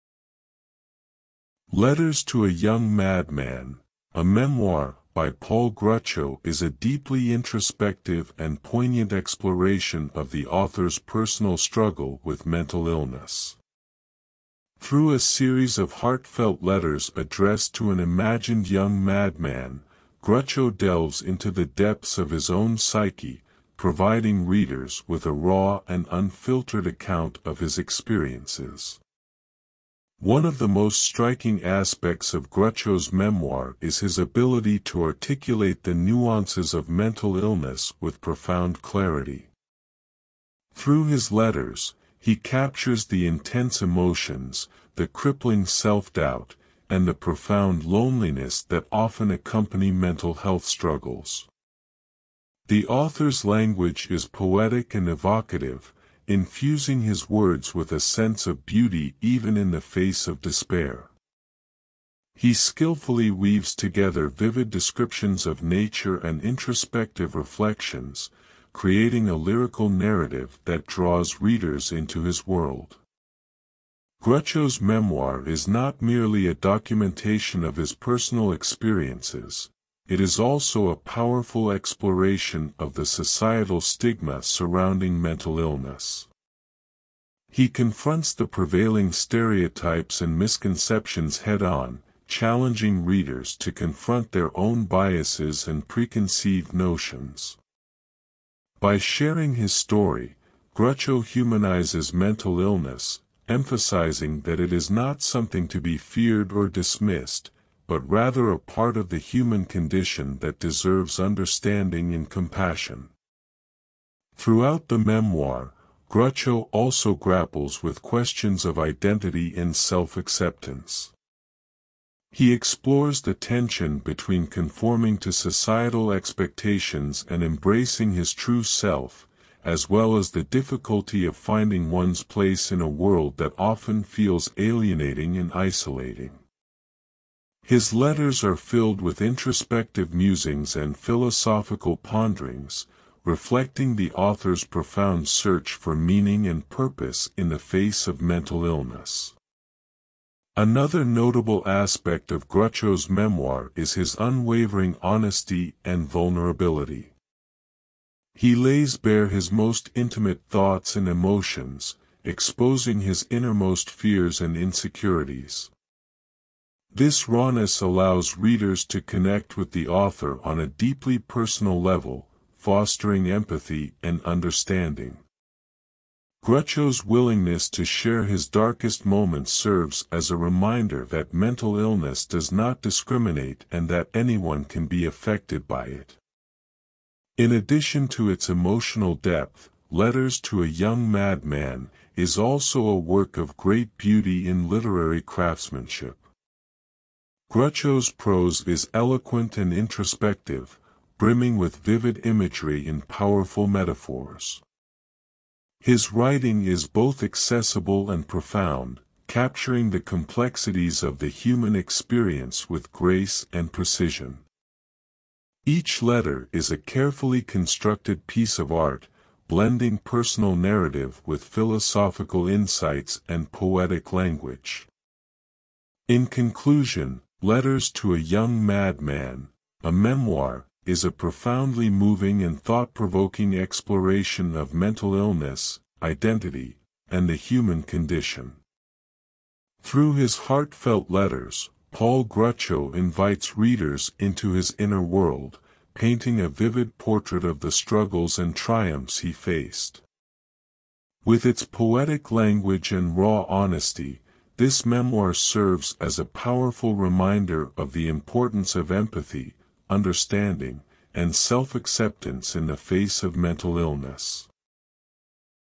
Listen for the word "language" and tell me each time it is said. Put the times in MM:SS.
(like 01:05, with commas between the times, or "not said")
00:53, 03:44, 04:12.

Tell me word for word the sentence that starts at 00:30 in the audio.
One of the most striking aspects of Gruchow's memoir is his ability to articulate the nuances of mental illness with profound clarity.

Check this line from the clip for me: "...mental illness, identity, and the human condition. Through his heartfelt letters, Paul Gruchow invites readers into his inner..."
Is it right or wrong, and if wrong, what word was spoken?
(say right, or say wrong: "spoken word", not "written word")
right.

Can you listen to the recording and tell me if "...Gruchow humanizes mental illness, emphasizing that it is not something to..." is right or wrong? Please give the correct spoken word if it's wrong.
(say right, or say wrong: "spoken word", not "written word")
right.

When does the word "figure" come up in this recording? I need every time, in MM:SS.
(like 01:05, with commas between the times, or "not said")
not said.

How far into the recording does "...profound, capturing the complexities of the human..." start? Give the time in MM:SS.
03:28.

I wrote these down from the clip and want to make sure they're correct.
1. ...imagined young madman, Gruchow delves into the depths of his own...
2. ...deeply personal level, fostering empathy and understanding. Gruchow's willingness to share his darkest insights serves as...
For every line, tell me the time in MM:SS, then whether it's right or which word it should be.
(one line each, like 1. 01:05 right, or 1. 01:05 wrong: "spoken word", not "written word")
1. 00:18 right
2. 02:50 wrong: "moments", not "insights".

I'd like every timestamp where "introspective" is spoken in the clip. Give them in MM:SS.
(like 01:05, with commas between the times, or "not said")
00:07, 01:06, 02:19, 03:19.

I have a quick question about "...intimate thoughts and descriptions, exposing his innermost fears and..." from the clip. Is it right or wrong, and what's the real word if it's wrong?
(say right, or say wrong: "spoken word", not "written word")
wrong: "emotions", not "descriptions".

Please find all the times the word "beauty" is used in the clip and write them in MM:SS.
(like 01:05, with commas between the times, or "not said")
00:58, 03:13.